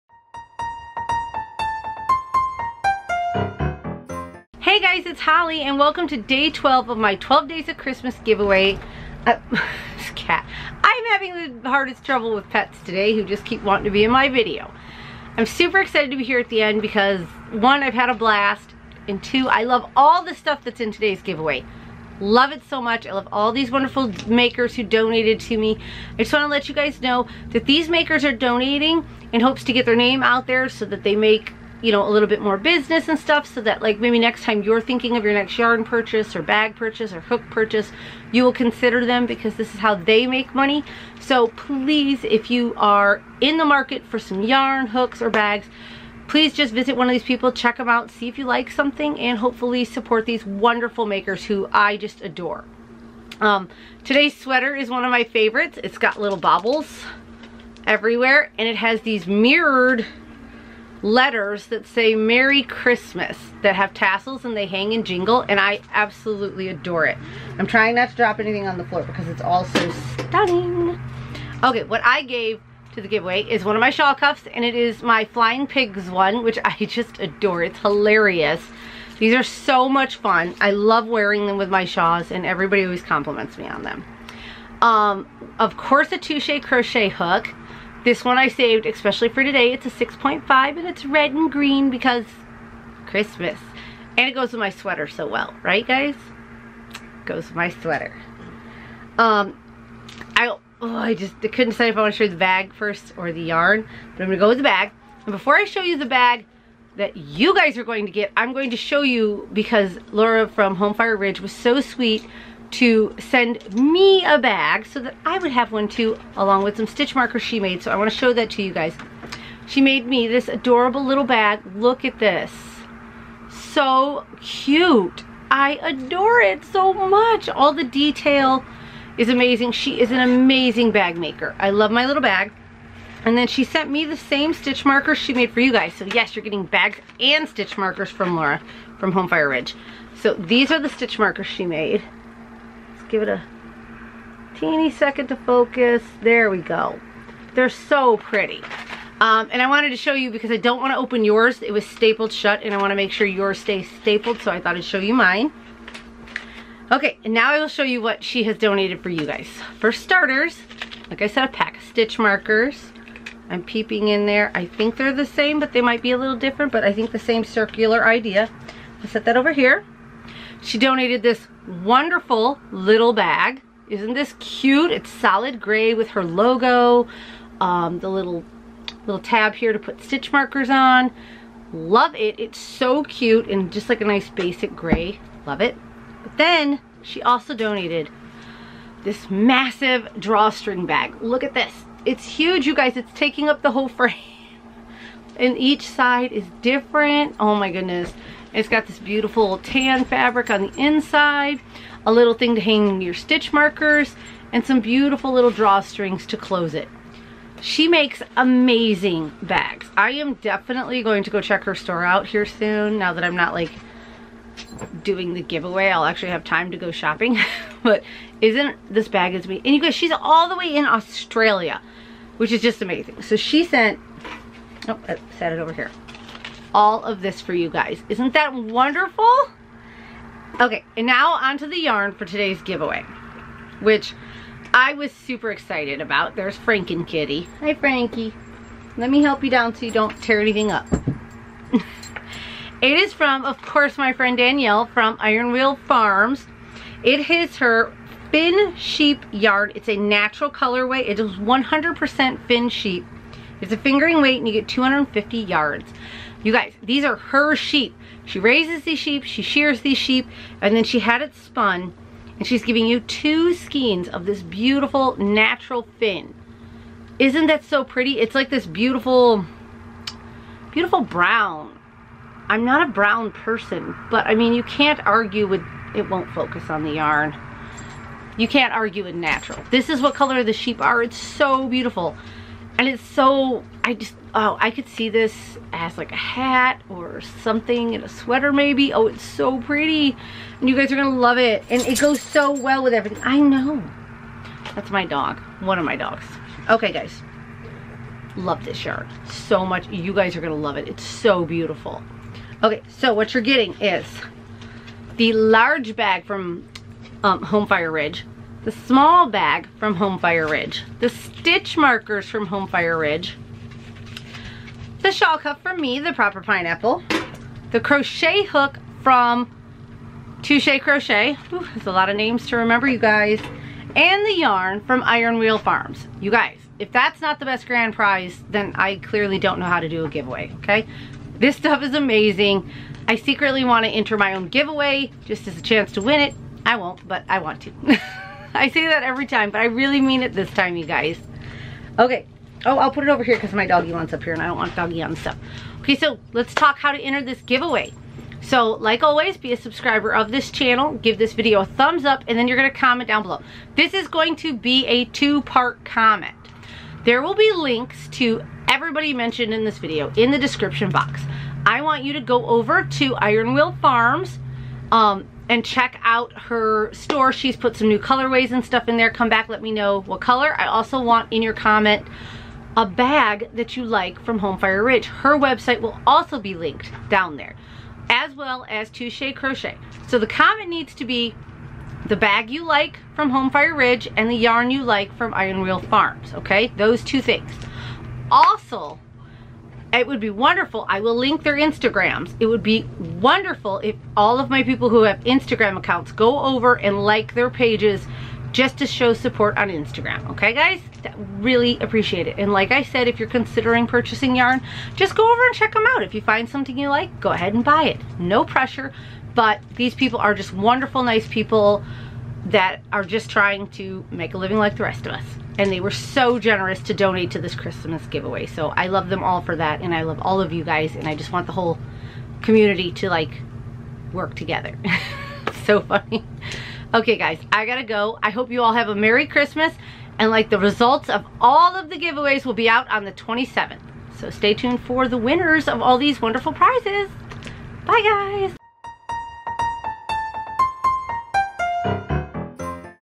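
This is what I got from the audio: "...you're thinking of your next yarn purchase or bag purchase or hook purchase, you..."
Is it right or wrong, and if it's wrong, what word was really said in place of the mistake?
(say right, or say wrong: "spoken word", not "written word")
right.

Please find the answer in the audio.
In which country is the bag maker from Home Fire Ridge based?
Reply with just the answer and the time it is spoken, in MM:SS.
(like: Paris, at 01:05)
Australia, at 03:40.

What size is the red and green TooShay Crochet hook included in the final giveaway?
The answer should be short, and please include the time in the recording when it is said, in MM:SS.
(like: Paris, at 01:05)
6.5, at 01:29.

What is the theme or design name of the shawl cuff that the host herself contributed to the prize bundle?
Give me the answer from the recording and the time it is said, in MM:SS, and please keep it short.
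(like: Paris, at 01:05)
Flying Pigs, at 01:15.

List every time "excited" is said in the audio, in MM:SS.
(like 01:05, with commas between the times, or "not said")
00:15, 03:55.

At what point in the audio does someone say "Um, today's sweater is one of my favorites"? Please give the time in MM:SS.
00:53.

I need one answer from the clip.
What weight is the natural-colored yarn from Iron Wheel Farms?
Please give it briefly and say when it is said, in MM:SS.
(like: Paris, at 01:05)
Fingering weight, at 04:13.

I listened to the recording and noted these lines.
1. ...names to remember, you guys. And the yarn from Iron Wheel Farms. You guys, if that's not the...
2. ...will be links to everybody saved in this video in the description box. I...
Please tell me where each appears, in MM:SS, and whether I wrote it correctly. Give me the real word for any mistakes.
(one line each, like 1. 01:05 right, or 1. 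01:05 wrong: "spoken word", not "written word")
1. 05:22 right
2. 05:57 wrong: "mentioned", not "saved".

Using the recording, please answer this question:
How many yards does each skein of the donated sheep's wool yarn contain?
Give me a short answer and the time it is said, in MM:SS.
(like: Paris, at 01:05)
250, at 04:14.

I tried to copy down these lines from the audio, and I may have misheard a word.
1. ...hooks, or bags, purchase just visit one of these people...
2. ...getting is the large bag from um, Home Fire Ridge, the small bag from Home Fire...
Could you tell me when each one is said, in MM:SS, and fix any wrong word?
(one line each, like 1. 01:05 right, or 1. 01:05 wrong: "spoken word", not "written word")
1. 00:44 wrong: "please", not "purchase"
2. 05:03 right.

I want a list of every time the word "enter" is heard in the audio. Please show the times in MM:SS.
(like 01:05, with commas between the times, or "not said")
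05:33, 05:46.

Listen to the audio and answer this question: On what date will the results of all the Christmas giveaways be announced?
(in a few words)
27th.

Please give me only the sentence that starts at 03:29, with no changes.
I am definitely going to go check her store out here soon now that I'm not like doing the giveaway.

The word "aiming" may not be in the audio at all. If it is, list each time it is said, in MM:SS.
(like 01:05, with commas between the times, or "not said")
not said.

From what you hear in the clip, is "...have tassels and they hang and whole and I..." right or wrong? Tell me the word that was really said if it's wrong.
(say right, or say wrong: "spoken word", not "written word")
wrong: "jingle", not "whole".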